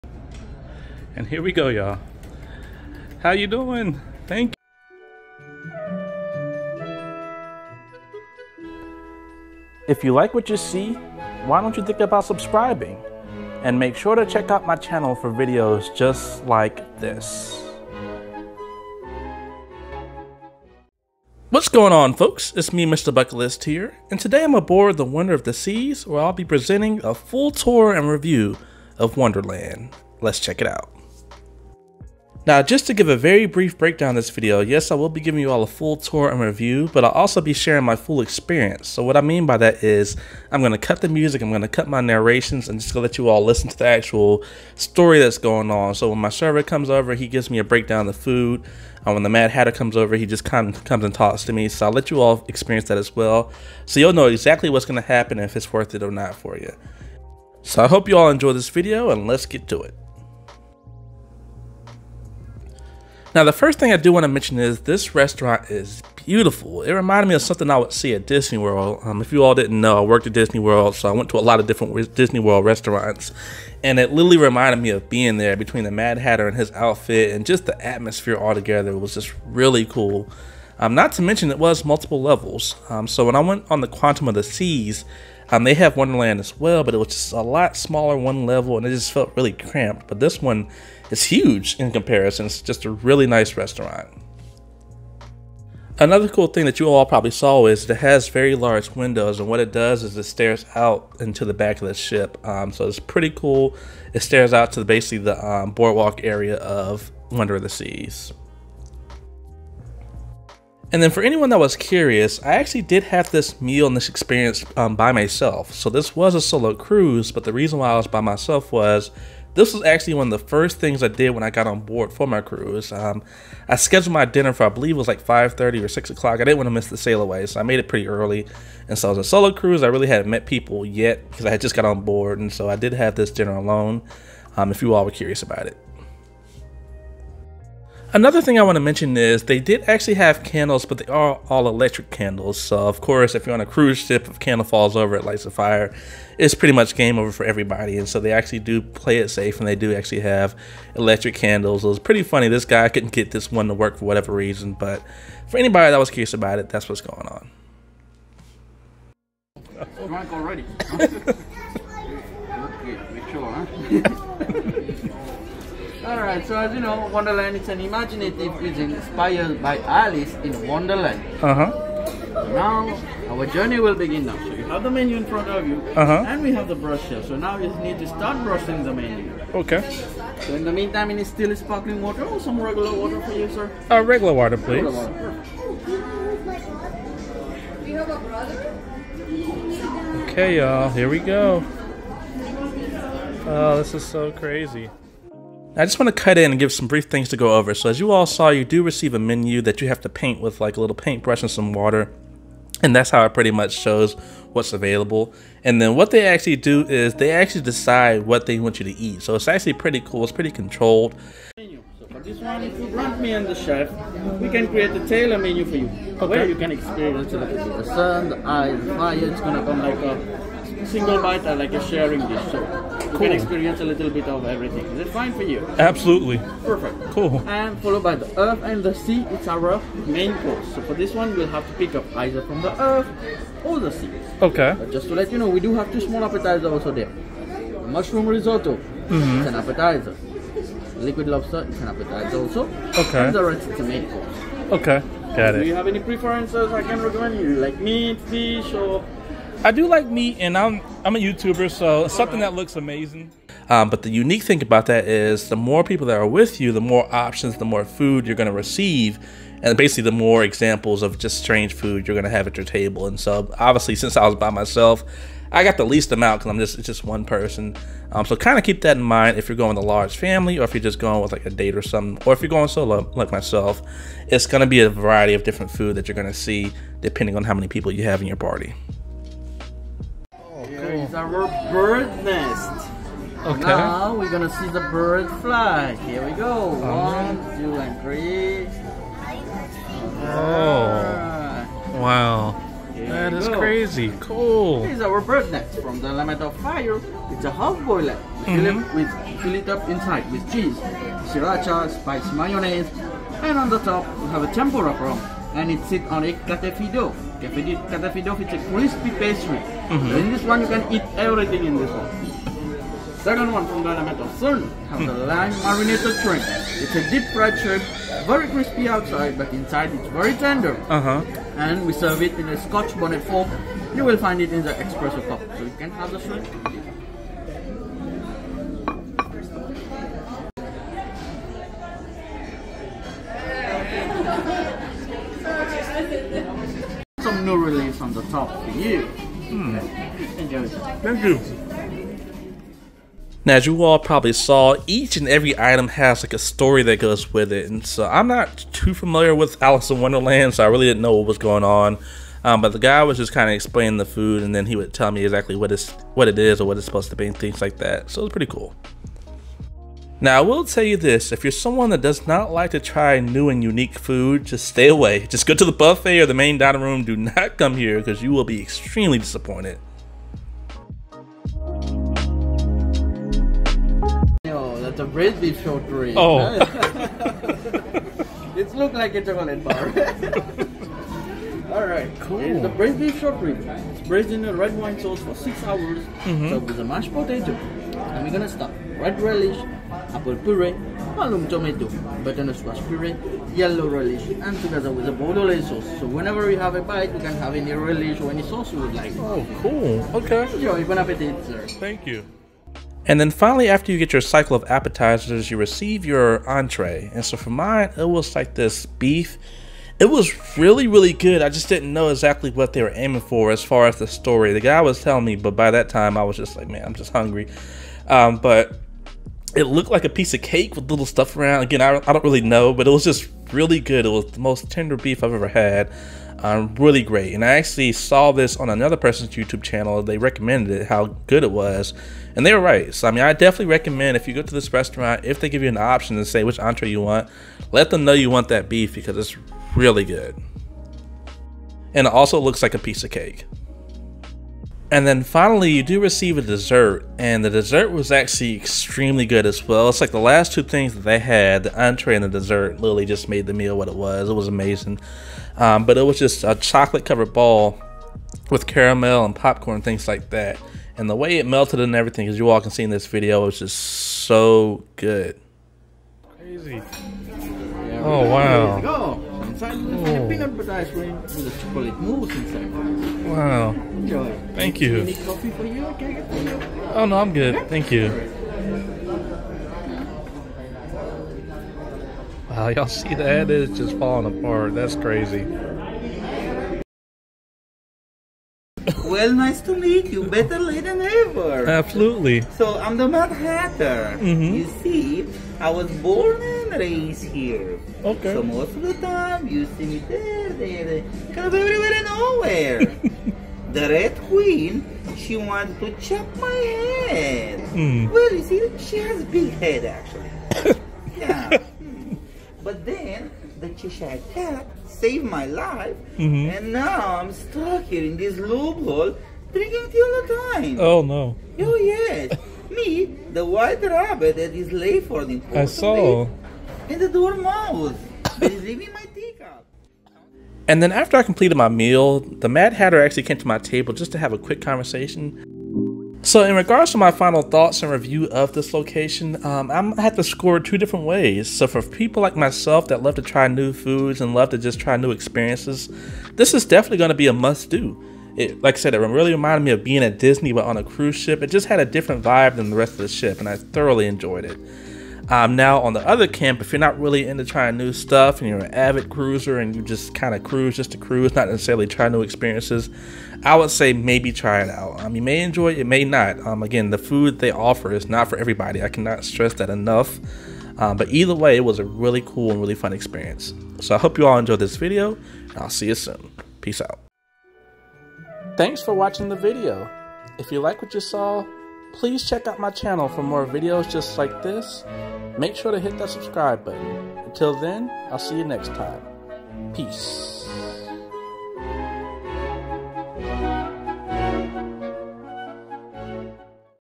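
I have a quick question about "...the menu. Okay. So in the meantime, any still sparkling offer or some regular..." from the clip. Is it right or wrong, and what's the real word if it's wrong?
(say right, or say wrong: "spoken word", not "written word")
wrong: "water", not "offer".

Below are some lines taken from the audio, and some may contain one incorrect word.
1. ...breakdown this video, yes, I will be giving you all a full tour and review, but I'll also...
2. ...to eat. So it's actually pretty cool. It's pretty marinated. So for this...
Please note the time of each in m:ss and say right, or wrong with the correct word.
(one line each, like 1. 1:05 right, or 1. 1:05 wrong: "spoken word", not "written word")
1. 0:33 right
2. 3:28 wrong: "controlled", not "marinated".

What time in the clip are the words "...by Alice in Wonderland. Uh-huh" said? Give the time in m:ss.
2:49.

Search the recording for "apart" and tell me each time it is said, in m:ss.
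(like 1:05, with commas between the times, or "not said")
8:04.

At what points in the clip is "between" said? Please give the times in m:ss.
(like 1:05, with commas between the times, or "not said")
1:15.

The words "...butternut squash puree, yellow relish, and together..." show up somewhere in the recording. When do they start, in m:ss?
6:32.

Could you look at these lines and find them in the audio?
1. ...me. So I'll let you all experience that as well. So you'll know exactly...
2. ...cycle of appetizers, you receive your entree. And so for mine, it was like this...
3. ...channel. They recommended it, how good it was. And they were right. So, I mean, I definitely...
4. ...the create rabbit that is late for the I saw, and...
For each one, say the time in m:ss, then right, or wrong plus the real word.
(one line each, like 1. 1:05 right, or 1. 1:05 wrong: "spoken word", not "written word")
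1. 0:51 right
2. 6:44 right
3. 7:09 right
4. 8:43 wrong: "white", not "create".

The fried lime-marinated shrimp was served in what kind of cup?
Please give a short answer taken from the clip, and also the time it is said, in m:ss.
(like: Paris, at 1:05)
Espresso cup, at 5:24.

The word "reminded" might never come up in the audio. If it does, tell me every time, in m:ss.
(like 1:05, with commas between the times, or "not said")
1:06, 1:14, 9:09.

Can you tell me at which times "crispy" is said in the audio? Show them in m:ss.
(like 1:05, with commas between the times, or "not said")
5:08, 5:18.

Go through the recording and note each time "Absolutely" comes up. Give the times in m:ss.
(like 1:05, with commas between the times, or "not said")
3:45, 8:11.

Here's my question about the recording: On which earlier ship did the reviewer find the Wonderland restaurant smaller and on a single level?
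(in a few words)
Quantum of the Seas.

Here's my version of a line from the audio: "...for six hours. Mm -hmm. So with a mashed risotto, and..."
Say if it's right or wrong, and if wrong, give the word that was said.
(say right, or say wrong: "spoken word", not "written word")
wrong: "potato", not "risotto".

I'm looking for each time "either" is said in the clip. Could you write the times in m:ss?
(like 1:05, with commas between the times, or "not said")
3:52, 9:31.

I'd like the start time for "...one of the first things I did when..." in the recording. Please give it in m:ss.
2:00.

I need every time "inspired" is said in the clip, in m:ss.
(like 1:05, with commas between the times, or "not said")
2:48.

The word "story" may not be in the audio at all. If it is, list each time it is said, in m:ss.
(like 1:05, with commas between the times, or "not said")
0:44, 5:46, 6:54.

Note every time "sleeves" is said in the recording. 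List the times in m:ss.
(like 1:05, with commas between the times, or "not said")
not said.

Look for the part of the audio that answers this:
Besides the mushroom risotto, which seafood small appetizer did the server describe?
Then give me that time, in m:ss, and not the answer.
4:01.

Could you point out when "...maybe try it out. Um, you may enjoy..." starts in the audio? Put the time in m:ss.
9:23.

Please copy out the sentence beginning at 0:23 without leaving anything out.
Bucketlist here, and today I'm aboard the Wonder of the Seas where I'll be presenting a full tour and review of Wonderland.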